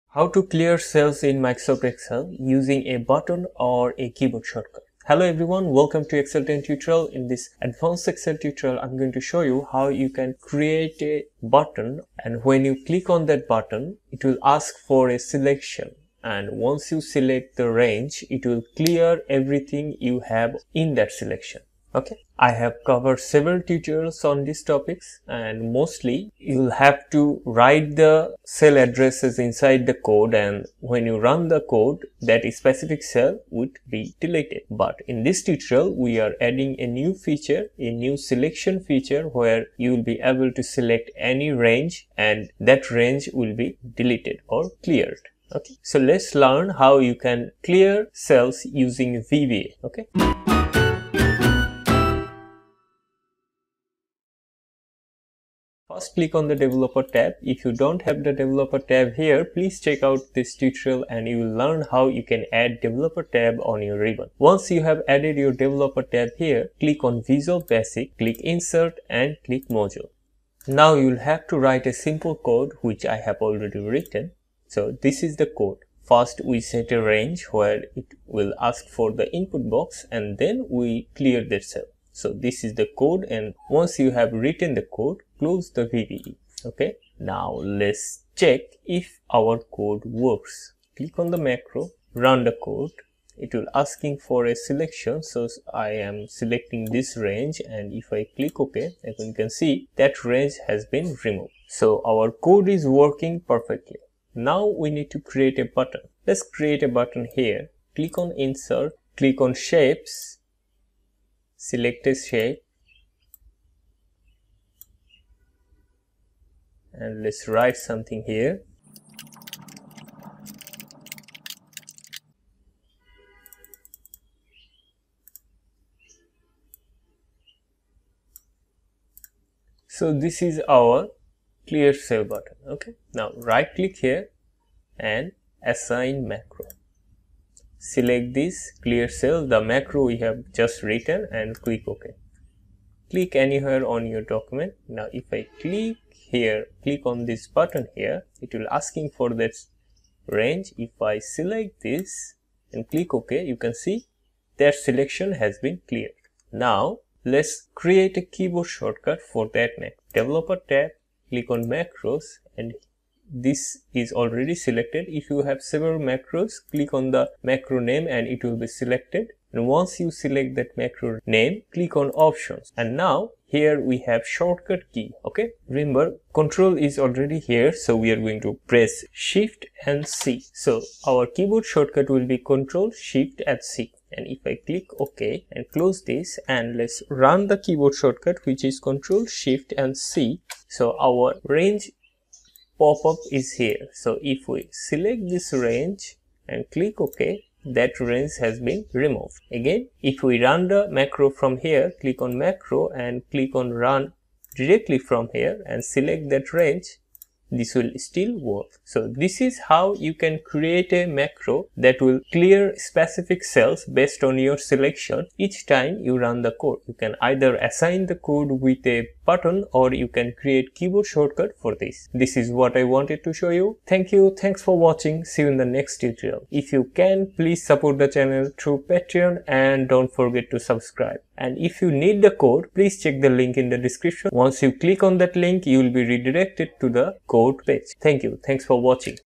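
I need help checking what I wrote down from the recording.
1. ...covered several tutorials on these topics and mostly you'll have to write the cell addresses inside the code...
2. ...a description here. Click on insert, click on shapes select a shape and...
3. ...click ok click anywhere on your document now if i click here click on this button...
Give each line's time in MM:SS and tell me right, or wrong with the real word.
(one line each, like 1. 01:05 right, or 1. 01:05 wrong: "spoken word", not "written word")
1. 00:22 right
2. 01:46 wrong: "button", not "description"
3. 02:21 right.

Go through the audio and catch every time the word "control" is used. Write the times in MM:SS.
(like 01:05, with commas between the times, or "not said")
02:56, 03:02.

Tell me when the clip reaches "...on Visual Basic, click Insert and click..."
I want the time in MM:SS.
01:07.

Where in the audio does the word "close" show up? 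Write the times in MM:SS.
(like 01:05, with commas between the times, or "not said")
01:25, 03:05.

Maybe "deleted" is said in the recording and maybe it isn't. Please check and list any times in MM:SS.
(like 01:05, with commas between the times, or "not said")
00:34, 00:43.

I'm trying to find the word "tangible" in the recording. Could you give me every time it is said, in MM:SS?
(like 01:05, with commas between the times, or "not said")
not said.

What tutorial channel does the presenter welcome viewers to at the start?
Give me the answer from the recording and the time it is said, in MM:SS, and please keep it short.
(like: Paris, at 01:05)
Excel 10, at 00:06.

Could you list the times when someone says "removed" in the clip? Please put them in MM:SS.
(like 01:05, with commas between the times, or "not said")
01:41, 03:18.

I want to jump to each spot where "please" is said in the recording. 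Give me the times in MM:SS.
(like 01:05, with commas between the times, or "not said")
00:59, 03:47, 03:52.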